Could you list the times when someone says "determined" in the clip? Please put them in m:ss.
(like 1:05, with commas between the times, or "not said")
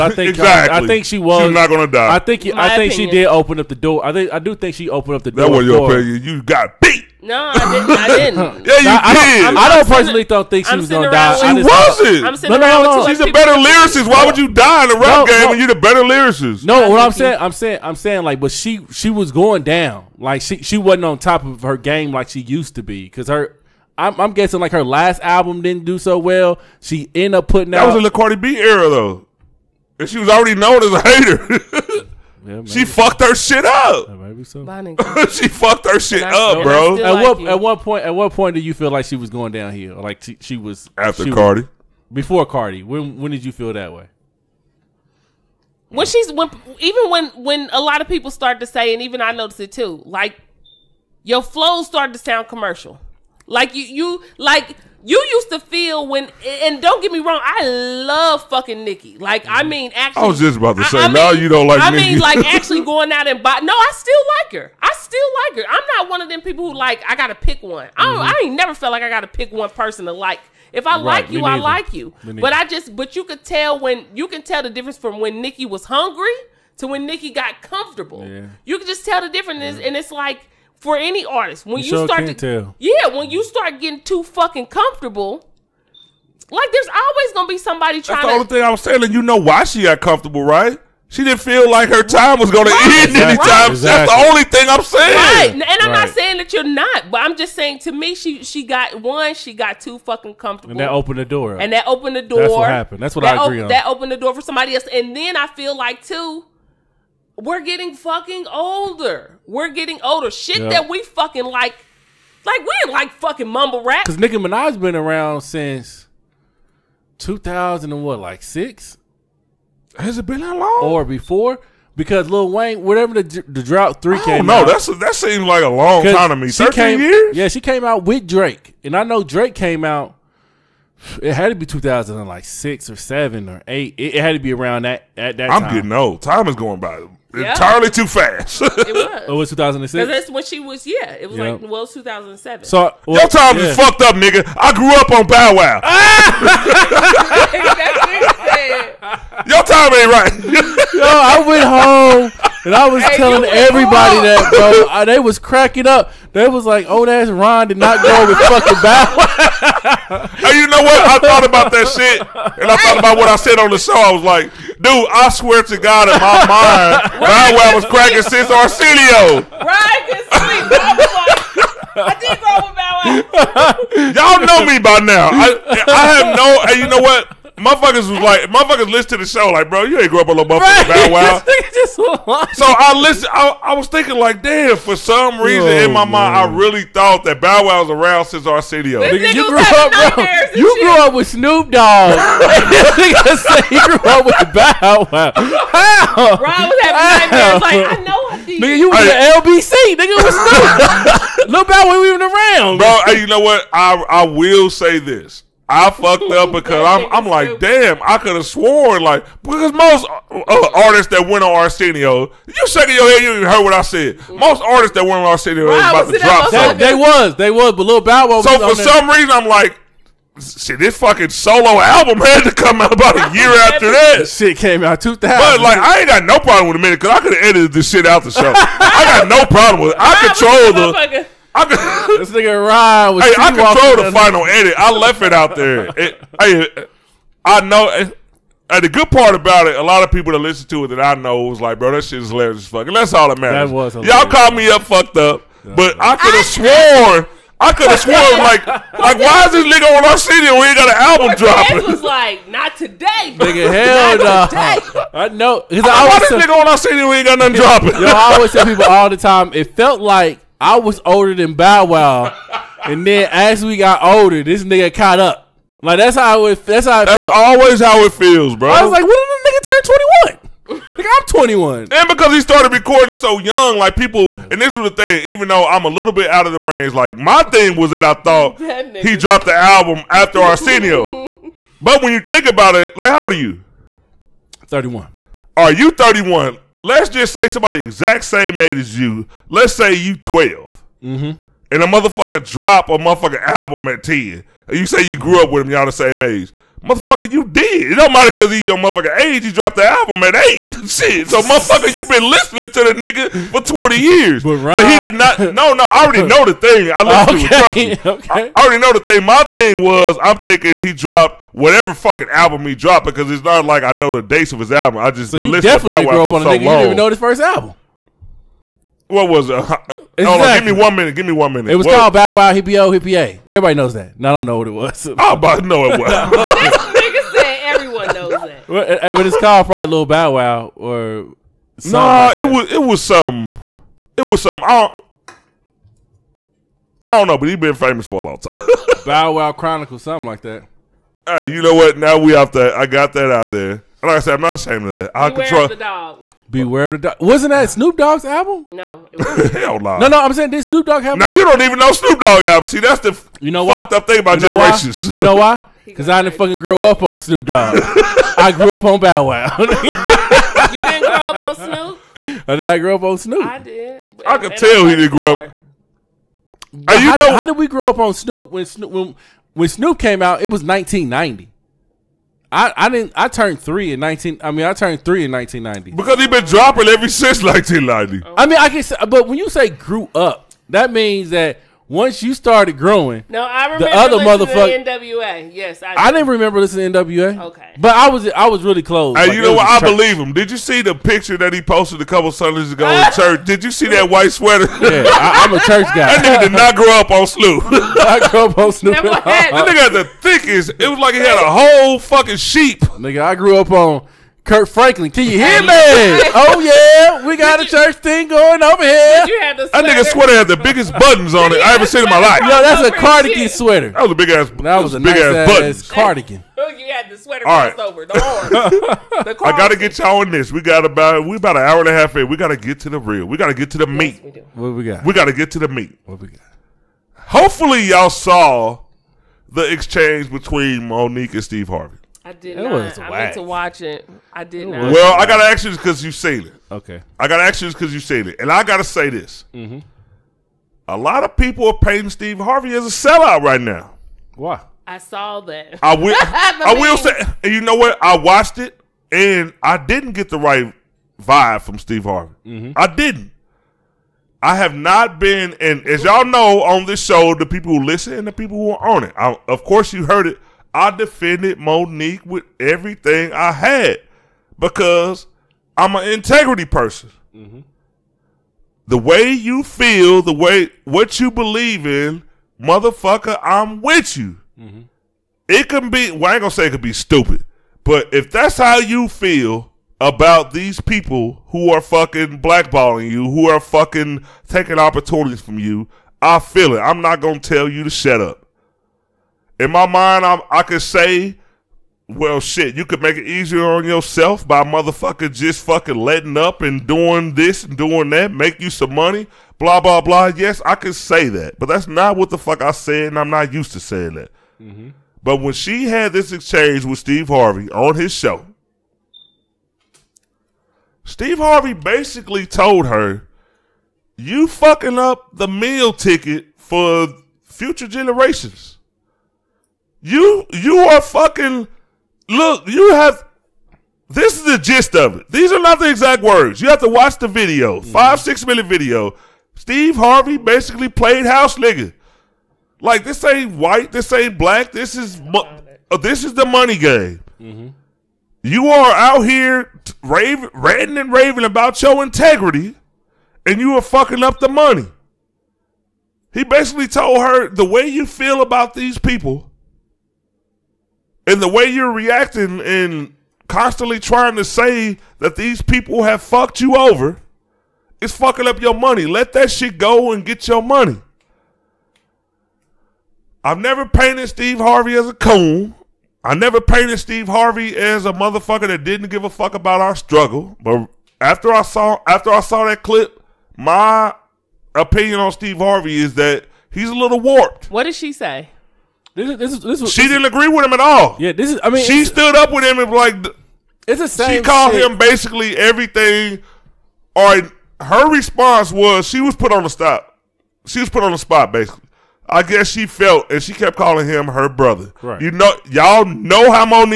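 not said.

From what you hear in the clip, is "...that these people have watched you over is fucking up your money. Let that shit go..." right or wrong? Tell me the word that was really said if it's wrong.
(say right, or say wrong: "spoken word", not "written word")
wrong: "fucked", not "watched".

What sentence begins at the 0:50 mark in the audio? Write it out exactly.
Like your flows started to sound commercial.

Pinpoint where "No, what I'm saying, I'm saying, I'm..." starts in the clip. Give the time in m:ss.
0:16.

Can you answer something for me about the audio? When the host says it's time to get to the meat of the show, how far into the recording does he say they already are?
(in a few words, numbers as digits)
An hour and a half.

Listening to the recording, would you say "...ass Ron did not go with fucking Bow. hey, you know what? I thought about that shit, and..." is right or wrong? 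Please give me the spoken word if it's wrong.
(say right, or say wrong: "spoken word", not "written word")
right.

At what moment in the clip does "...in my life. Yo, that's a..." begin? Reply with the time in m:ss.
6:52.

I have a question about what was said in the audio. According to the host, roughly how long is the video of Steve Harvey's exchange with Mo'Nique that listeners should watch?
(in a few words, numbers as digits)
5 or 6 minutes.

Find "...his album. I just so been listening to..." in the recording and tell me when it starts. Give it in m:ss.
5:14.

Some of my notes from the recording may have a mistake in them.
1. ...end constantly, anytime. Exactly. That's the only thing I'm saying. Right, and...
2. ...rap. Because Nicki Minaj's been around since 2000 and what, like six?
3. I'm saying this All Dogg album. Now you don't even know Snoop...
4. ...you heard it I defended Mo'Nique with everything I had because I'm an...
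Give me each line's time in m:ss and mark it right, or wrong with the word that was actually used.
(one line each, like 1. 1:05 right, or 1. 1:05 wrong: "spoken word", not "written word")
1. 1:32 wrong: "exactly", not "constantly"
2. 1:53 right
3. 5:50 wrong: "Snoop", not "All"
4. 7:39 right.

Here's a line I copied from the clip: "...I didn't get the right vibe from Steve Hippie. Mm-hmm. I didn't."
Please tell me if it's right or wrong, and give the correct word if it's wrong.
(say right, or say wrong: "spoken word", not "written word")
wrong: "Harvey", not "Hippie".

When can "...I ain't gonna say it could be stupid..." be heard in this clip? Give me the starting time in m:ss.
7:56.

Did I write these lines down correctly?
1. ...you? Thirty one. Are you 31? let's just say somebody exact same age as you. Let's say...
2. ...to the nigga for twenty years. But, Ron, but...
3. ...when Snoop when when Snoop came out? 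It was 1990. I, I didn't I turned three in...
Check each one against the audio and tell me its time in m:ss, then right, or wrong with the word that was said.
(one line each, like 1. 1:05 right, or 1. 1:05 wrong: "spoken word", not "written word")
1. 4:43 right
2. 5:02 right
3. 6:08 right.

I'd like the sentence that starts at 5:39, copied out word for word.
Bow Wow Chronicles, something like that.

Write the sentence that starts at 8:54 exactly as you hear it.
This is mo- uh, this is the money game.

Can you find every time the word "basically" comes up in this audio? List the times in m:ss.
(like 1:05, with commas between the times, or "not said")
8:31, 8:50, 9:06, 9:44, 9:51.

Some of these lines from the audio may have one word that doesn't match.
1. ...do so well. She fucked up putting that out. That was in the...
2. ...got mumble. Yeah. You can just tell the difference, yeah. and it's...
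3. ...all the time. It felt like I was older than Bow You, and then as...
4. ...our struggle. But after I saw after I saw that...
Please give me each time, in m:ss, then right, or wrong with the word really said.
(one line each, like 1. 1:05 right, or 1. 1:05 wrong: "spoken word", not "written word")
1. 0:25 wrong: "ended", not "fucked"
2. 1:17 wrong: "comfortable", not "mumble"
3. 4:18 wrong: "Wow", not "You"
4. 9:29 right.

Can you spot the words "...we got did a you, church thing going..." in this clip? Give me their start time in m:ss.
6:47.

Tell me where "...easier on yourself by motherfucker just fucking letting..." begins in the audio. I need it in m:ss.
8:13.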